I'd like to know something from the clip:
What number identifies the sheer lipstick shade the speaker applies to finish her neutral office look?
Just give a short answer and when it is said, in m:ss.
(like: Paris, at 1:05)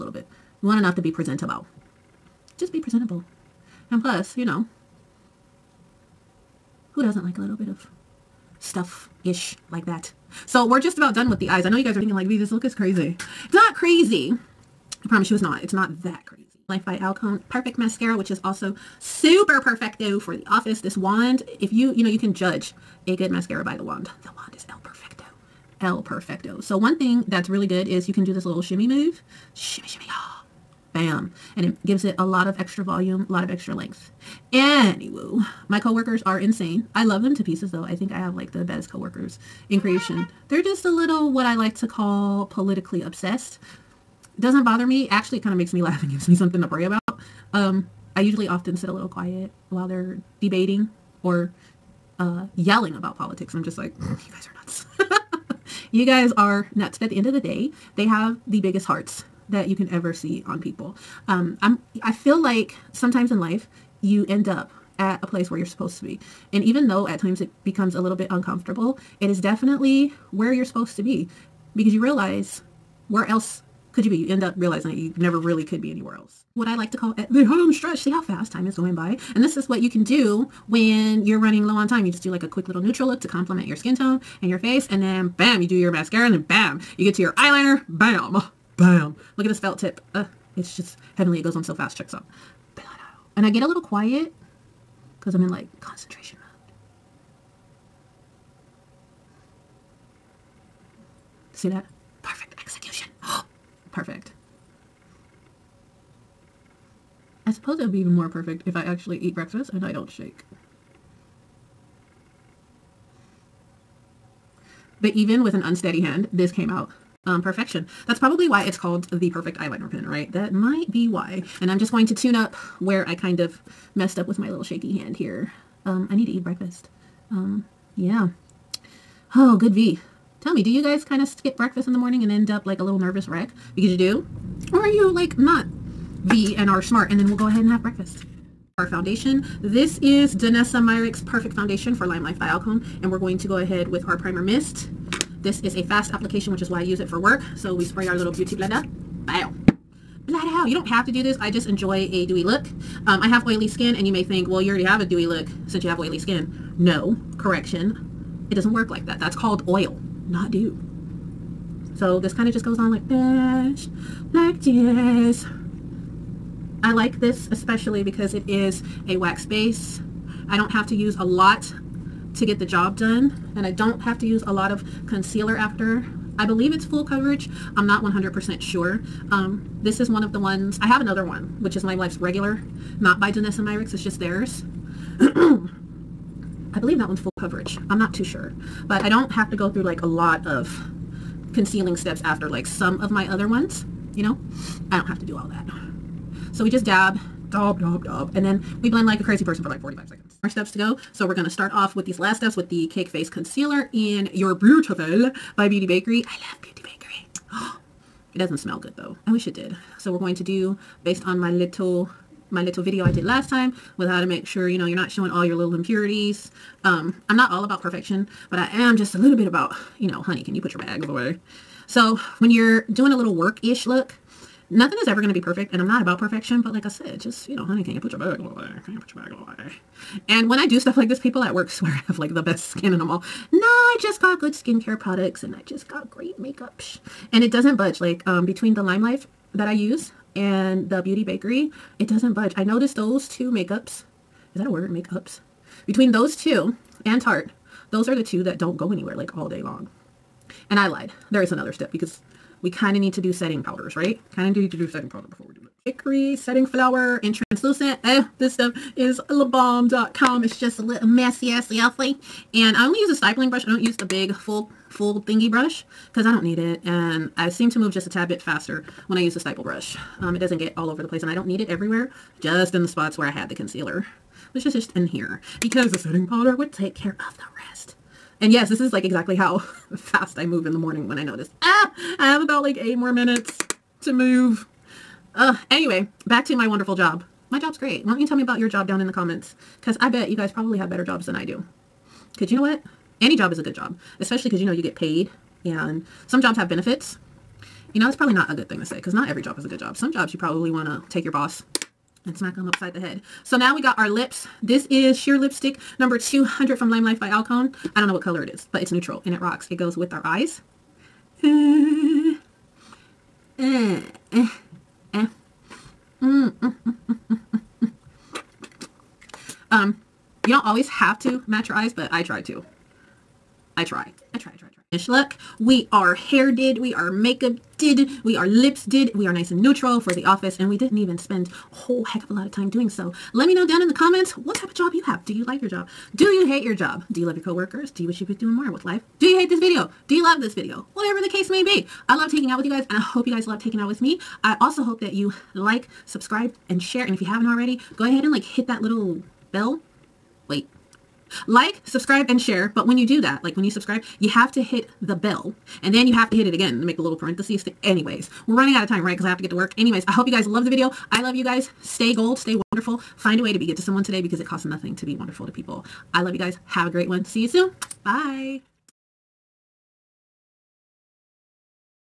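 200, at 5:05.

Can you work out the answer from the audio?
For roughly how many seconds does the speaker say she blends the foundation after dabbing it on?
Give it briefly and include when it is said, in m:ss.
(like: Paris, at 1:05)
45, at 3:19.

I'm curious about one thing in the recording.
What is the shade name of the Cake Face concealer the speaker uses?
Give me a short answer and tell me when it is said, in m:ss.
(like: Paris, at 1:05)
Your Beautiful, at 3:24.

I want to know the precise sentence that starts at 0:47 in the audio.
Um, I usually often sit a little quiet while they're debating or uh, yelling about politics.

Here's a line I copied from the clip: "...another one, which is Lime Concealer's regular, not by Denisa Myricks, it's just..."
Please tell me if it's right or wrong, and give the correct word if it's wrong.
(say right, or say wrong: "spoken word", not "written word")
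wrong: "Life", not "Concealer".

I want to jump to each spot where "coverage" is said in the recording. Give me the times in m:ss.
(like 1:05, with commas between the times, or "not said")
2:57, 3:07.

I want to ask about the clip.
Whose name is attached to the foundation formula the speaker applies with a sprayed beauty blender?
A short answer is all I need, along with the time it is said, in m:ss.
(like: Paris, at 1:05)
Danessa Myricks, at 2:20.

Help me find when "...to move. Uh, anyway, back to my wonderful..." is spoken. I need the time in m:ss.
4:44.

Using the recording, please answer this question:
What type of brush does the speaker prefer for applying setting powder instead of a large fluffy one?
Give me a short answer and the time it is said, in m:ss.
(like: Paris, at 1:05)
stippling brush, at 4:23.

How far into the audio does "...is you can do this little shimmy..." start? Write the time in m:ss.
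0:27.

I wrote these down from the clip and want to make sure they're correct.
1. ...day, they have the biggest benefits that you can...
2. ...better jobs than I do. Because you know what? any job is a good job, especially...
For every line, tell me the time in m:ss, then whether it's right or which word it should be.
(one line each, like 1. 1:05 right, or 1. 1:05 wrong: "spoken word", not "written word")
1. 0:57 wrong: "hearts", not "benefits"
2. 4:50 right.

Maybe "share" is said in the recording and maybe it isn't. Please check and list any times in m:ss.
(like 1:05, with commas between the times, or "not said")
5:46, 5:52.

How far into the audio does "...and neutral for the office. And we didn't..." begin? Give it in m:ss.
5:29.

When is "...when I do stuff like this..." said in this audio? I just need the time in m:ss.
3:50.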